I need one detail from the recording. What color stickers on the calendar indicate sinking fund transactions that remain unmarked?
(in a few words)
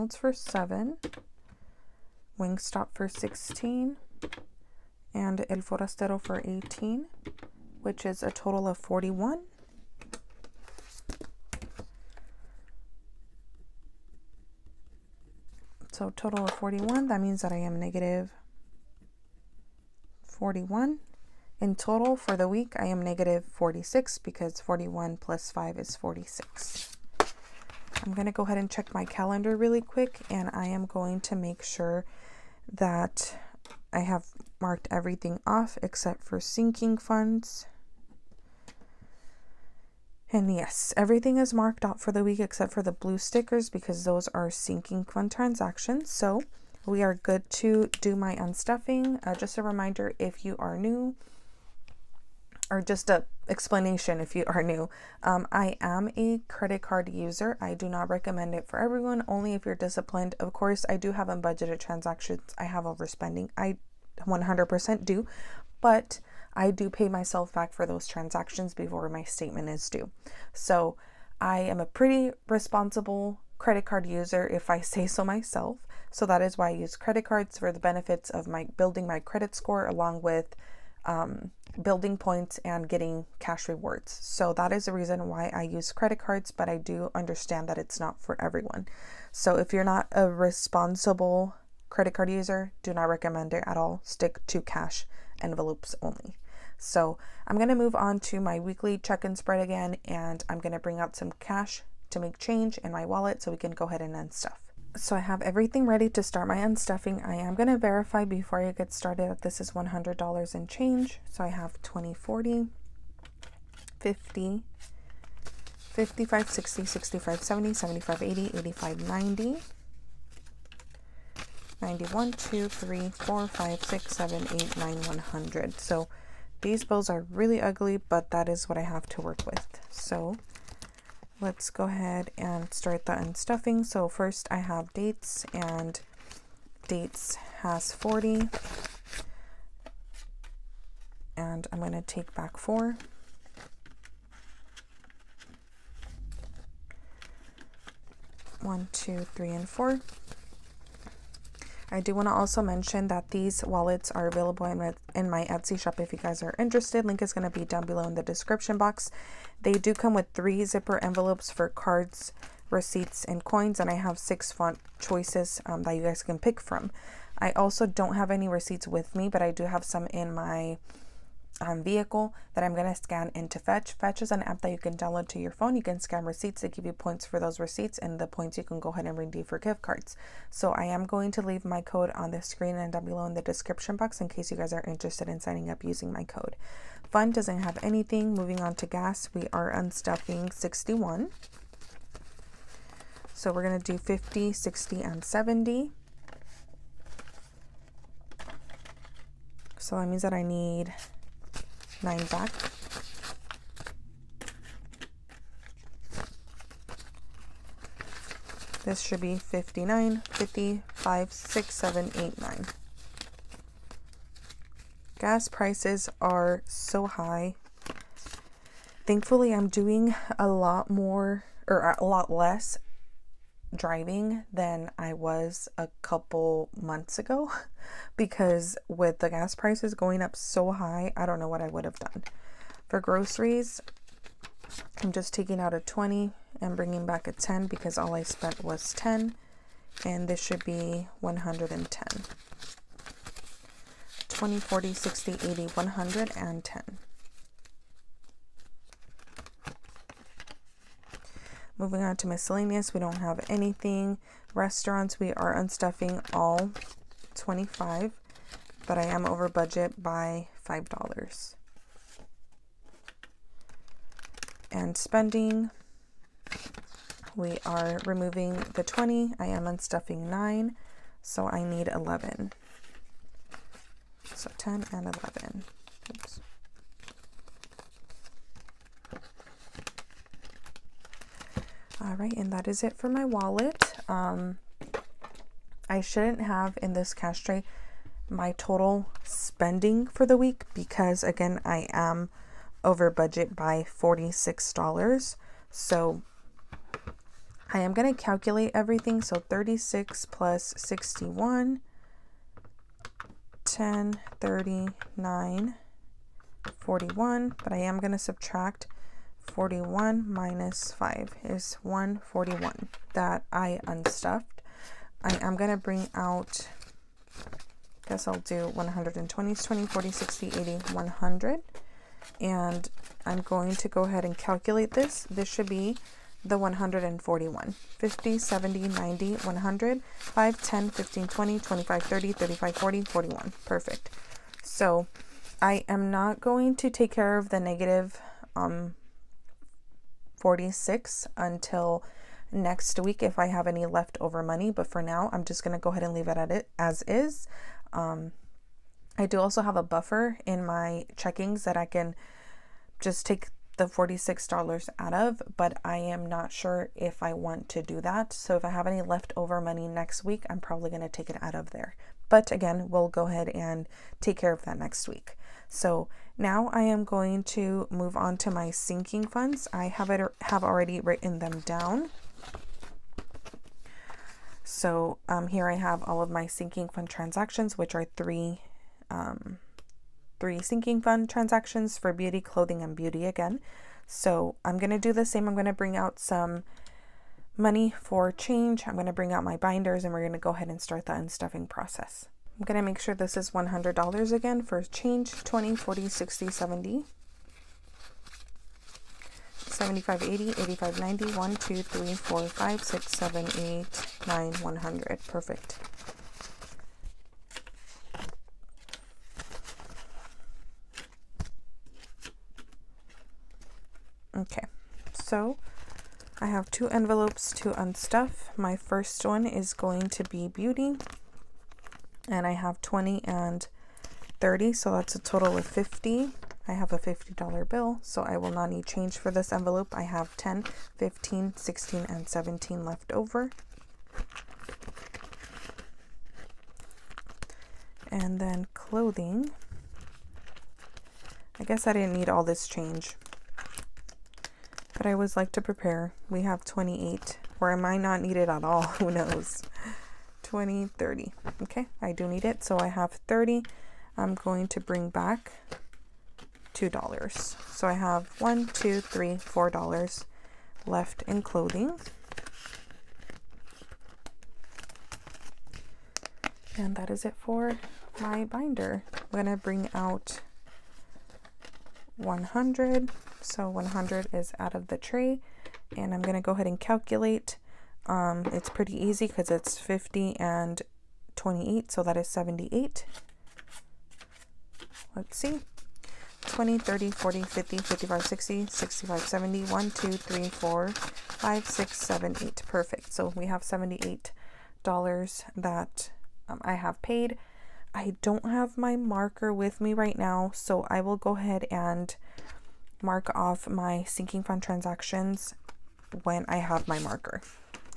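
Blue.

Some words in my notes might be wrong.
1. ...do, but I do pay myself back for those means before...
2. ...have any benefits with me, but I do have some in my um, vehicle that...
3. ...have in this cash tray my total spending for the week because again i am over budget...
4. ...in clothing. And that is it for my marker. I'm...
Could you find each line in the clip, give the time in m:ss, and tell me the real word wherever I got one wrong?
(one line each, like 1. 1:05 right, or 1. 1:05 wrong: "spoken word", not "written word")
1. 1:05 wrong: "transactions", not "means"
2. 2:48 wrong: "receipts", not "benefits"
3. 4:46 right
4. 7:41 wrong: "binder", not "marker".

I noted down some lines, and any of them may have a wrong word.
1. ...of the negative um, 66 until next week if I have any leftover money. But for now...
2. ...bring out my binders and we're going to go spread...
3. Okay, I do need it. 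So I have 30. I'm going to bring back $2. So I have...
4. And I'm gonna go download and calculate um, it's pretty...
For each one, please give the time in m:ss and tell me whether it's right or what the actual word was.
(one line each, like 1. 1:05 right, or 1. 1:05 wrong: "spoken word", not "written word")
1. 5:37 wrong: "46", not "66"
2. 6:29 wrong: "ahead", not "spread"
3. 7:31 right
4. 7:55 wrong: "ahead", not "download".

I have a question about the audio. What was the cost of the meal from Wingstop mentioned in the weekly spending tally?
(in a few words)
16.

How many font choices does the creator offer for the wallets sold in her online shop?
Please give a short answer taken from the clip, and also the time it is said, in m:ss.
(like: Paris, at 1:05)
6, at 2:44.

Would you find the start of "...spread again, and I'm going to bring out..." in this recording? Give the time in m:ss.
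1:39.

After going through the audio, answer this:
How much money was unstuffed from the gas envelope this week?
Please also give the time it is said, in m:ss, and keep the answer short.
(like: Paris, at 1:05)
61, at 3:09.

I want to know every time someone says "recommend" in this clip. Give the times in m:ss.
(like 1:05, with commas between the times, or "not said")
0:58, 1:33.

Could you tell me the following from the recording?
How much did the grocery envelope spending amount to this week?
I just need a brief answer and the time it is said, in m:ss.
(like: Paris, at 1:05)
10, at 3:57.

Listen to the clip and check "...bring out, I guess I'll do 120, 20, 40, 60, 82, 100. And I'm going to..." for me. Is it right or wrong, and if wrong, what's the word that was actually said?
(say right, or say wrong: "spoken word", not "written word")
wrong: "80", not "82".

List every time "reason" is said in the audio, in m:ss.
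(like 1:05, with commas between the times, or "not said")
1:24.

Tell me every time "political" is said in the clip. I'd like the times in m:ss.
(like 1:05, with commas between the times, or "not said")
not said.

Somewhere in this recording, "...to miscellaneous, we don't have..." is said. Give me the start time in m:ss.
4:12.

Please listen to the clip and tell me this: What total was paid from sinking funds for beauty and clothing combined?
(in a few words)
78.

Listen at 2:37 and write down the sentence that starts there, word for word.
Link is going to be down below in the description box.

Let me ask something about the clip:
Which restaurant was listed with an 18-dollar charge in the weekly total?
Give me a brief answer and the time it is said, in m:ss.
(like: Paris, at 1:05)
El Forastero, at 0:05.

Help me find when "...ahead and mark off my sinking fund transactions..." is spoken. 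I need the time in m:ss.
8:21.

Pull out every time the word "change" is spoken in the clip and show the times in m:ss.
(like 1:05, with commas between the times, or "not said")
1:42, 1:50, 6:28, 6:34, 7:08, 7:22.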